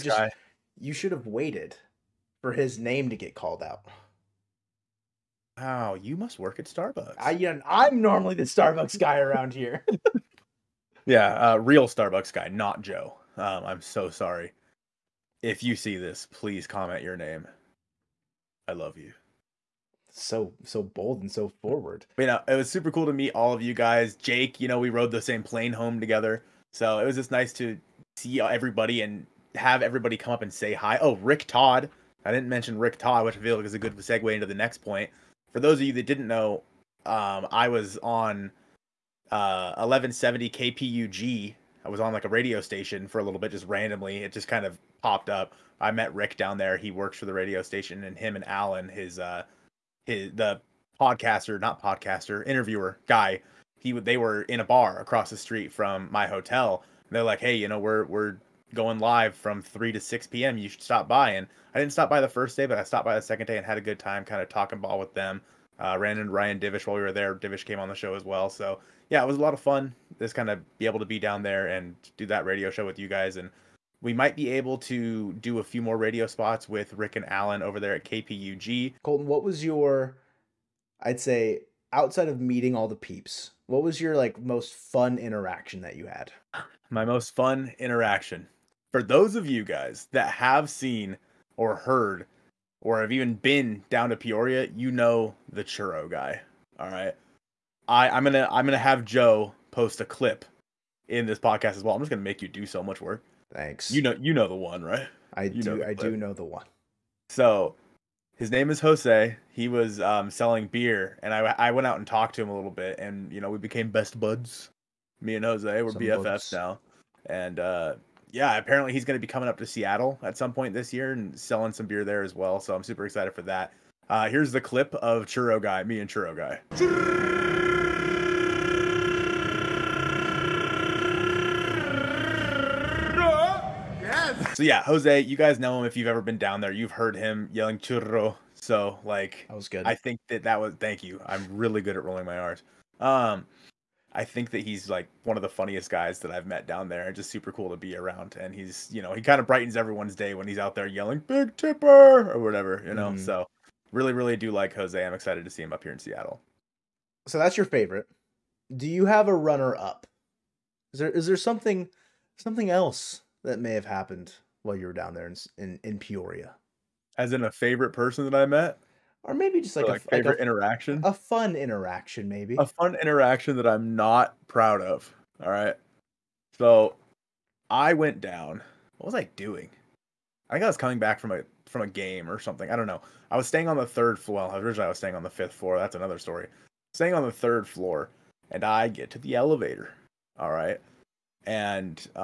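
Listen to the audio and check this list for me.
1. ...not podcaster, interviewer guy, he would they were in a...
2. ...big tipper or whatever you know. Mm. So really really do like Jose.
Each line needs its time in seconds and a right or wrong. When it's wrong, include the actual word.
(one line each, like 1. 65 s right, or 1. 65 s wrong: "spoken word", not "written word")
1. 51 s right
2. 151 s right.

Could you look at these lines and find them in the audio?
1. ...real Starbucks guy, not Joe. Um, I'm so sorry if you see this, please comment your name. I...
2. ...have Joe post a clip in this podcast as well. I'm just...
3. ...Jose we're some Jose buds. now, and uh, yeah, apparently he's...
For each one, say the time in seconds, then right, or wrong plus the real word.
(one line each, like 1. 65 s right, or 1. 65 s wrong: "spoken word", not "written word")
1. 11 s right
2. 98 s right
3. 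115 s wrong: "BFFs", not "Jose".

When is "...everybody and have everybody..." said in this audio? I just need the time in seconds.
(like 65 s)
28 s.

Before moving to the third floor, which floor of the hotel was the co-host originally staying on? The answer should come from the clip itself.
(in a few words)
Fifth floor.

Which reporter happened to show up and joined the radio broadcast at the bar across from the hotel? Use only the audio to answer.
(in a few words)
Ryan Divish.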